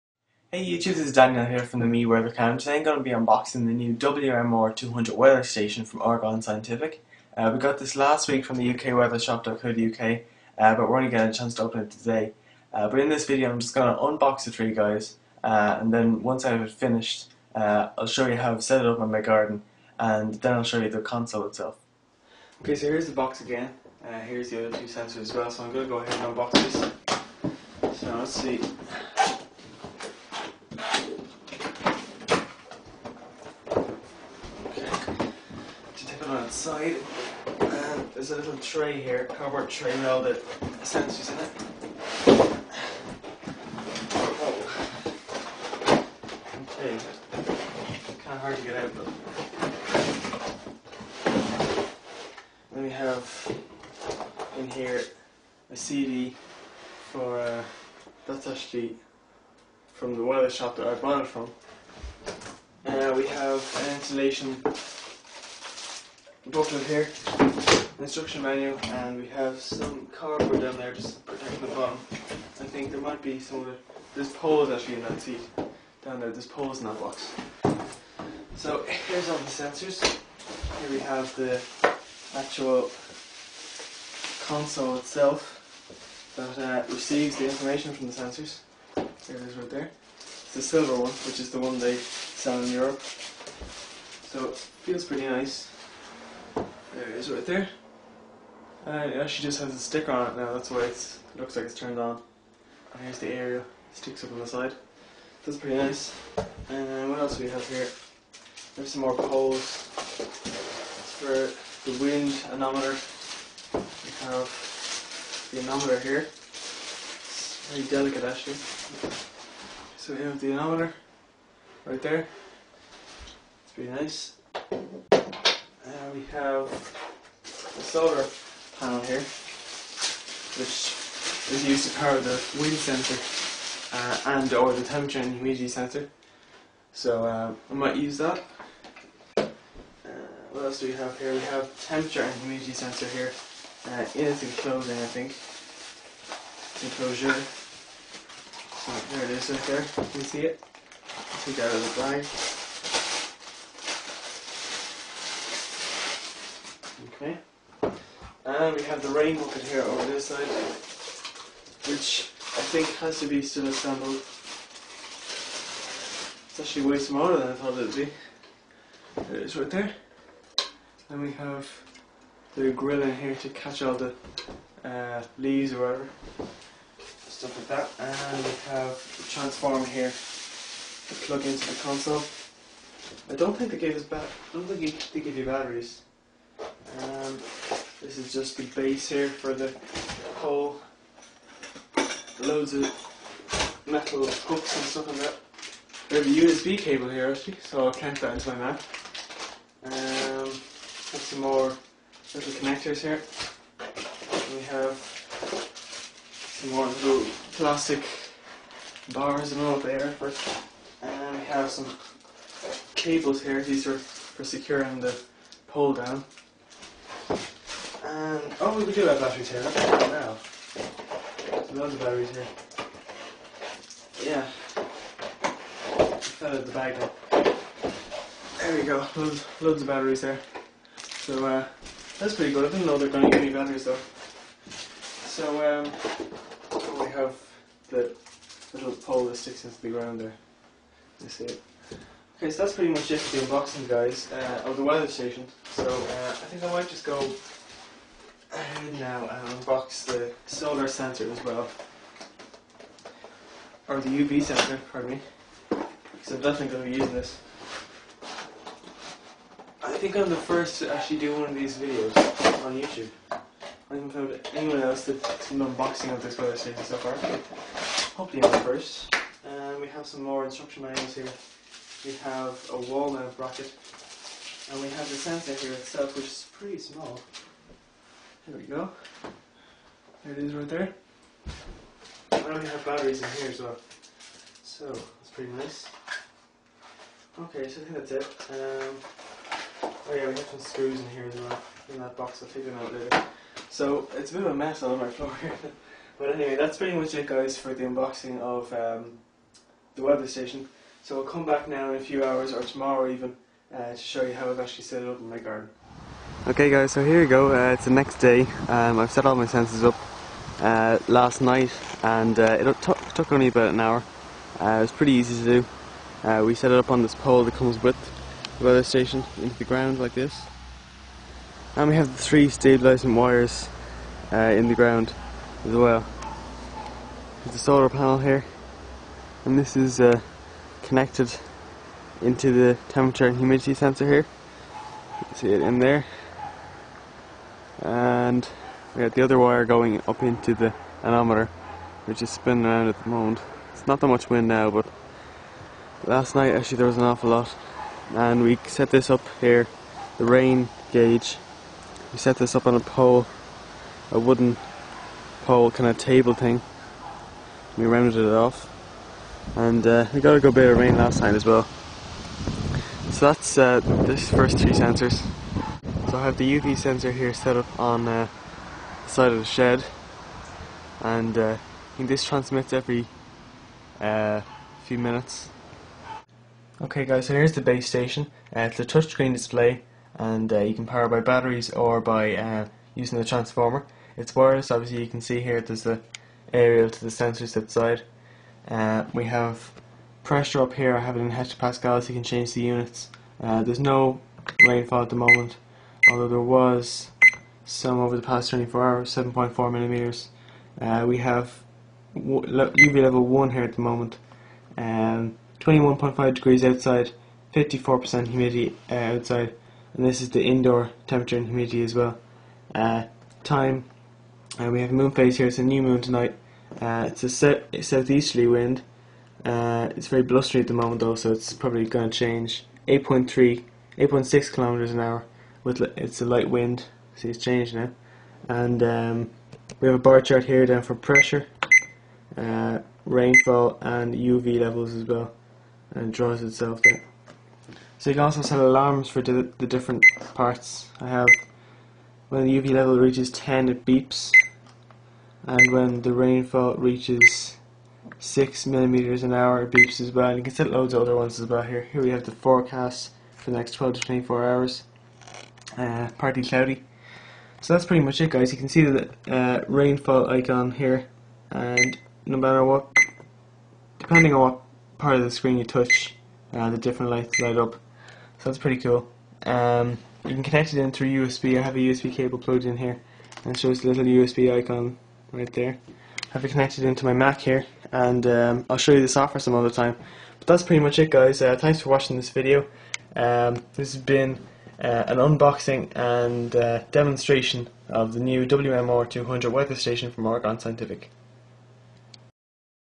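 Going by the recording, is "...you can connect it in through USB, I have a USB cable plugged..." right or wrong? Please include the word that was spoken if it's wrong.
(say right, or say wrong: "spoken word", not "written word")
right.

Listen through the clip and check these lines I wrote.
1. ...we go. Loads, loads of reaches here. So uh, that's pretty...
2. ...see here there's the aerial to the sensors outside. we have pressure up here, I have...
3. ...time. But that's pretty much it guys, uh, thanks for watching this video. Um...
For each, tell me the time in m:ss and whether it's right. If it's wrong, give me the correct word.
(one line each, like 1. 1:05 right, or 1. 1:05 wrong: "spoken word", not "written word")
1. 3:48 wrong: "batteries", not "reaches"
2. 6:25 right
3. 7:59 right.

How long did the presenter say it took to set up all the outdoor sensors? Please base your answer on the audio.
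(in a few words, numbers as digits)
about an hour.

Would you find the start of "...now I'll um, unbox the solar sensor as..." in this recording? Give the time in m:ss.
4:08.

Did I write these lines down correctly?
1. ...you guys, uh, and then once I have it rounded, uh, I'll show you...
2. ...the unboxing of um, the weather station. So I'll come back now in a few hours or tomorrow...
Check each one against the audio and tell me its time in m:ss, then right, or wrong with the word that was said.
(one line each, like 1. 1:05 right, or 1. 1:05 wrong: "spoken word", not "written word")
1. 0:14 wrong: "finished", not "rounded"
2. 4:57 right.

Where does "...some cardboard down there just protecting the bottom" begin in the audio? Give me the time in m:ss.
1:09.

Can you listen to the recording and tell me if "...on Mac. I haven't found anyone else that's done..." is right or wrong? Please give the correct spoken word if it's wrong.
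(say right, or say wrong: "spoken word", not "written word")
wrong: "YouTube", not "Mac".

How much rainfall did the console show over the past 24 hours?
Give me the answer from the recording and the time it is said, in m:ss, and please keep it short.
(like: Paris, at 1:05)
7.4 millimeters, at 6:39.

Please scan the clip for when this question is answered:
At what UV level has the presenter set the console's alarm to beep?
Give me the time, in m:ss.
7:23.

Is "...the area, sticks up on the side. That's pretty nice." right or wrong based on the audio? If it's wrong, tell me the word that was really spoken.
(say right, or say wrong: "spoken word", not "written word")
right.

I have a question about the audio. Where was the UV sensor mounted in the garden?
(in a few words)
side of the shed.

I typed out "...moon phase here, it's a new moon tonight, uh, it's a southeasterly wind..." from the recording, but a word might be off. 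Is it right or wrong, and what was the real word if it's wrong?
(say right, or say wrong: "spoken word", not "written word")
right.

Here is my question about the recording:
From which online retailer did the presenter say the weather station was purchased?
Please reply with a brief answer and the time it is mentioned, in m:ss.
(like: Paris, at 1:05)
ukweathershop.co.uk, at 0:08.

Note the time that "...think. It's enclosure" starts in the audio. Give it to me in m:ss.
2:25.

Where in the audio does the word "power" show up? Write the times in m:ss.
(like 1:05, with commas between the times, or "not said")
2:11, 6:20.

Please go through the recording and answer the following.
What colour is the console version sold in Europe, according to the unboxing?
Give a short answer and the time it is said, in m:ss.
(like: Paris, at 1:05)
silver, at 1:30.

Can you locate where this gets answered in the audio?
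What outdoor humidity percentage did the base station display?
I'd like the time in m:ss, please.
6:47.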